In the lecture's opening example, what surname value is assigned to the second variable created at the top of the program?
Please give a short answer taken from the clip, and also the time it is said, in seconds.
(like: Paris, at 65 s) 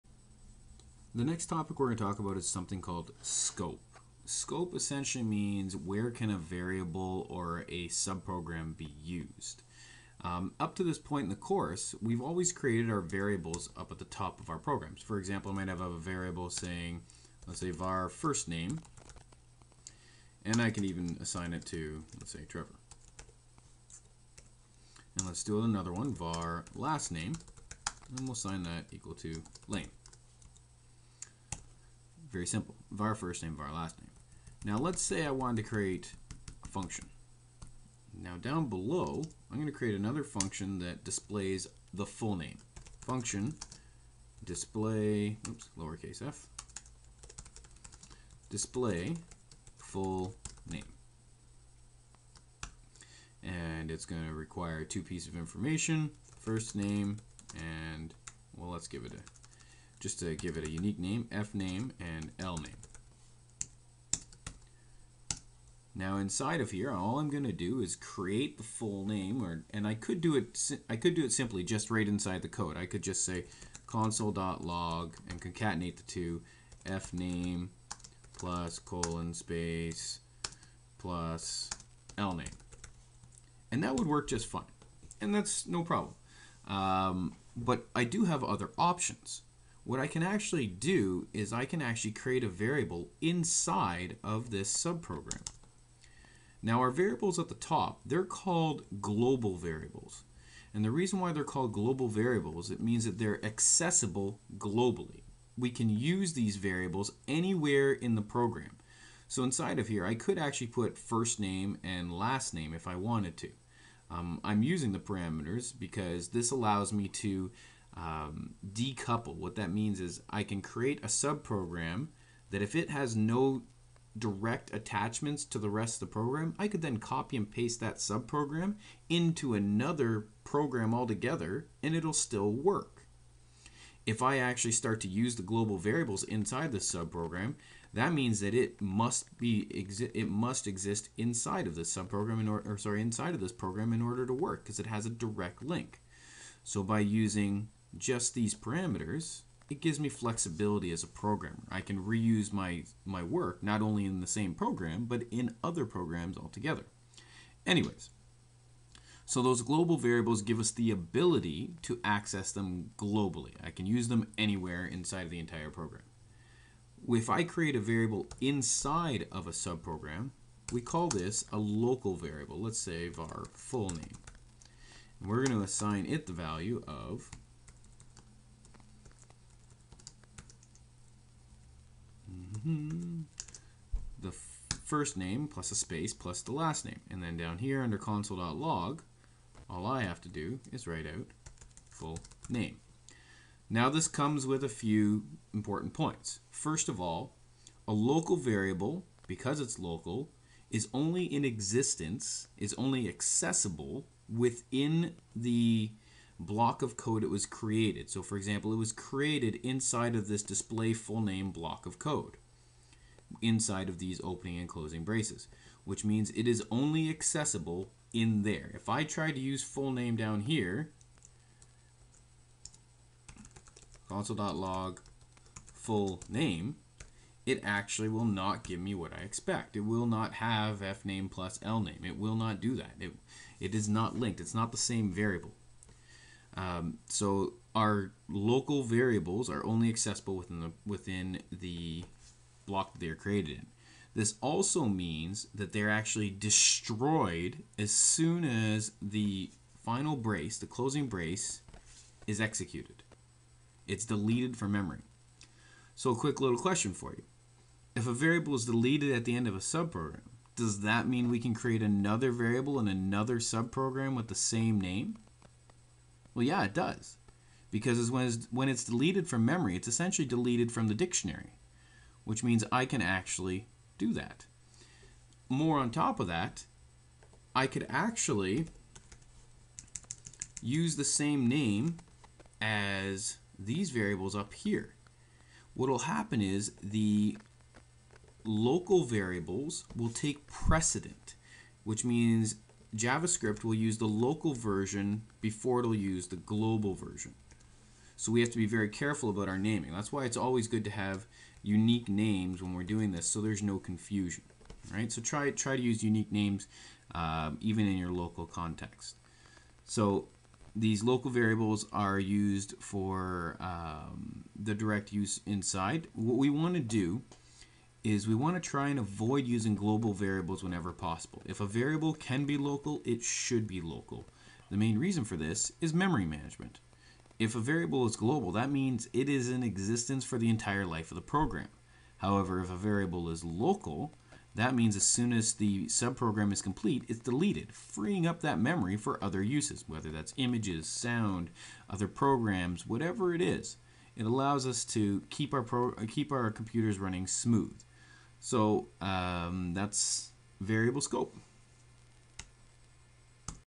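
Lane, at 29 s.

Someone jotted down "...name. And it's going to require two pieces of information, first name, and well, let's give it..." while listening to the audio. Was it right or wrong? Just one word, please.
right.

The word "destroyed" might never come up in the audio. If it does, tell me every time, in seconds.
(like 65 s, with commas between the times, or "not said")
246 s.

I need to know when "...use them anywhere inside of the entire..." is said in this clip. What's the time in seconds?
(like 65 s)
163 s.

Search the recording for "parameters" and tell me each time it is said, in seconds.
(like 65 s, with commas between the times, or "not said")
114 s, 148 s.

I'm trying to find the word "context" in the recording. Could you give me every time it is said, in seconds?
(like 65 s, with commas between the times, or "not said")
308 s.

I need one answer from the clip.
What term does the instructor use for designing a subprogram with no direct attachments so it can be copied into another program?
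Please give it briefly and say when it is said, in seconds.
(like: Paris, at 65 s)
decouple, at 118 s.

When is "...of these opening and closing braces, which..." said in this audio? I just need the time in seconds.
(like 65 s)
213 s.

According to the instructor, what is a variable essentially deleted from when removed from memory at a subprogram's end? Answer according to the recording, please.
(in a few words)
The dictionary.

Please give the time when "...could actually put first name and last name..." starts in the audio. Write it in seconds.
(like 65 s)
110 s.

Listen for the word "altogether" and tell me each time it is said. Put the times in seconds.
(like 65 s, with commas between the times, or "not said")
130 s, 156 s.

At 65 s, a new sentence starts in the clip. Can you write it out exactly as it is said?
Now inside of here, all I'm going to do is create the full name, or and I could do it.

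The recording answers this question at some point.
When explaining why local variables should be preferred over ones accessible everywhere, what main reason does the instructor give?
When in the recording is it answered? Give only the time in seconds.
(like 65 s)
325 s.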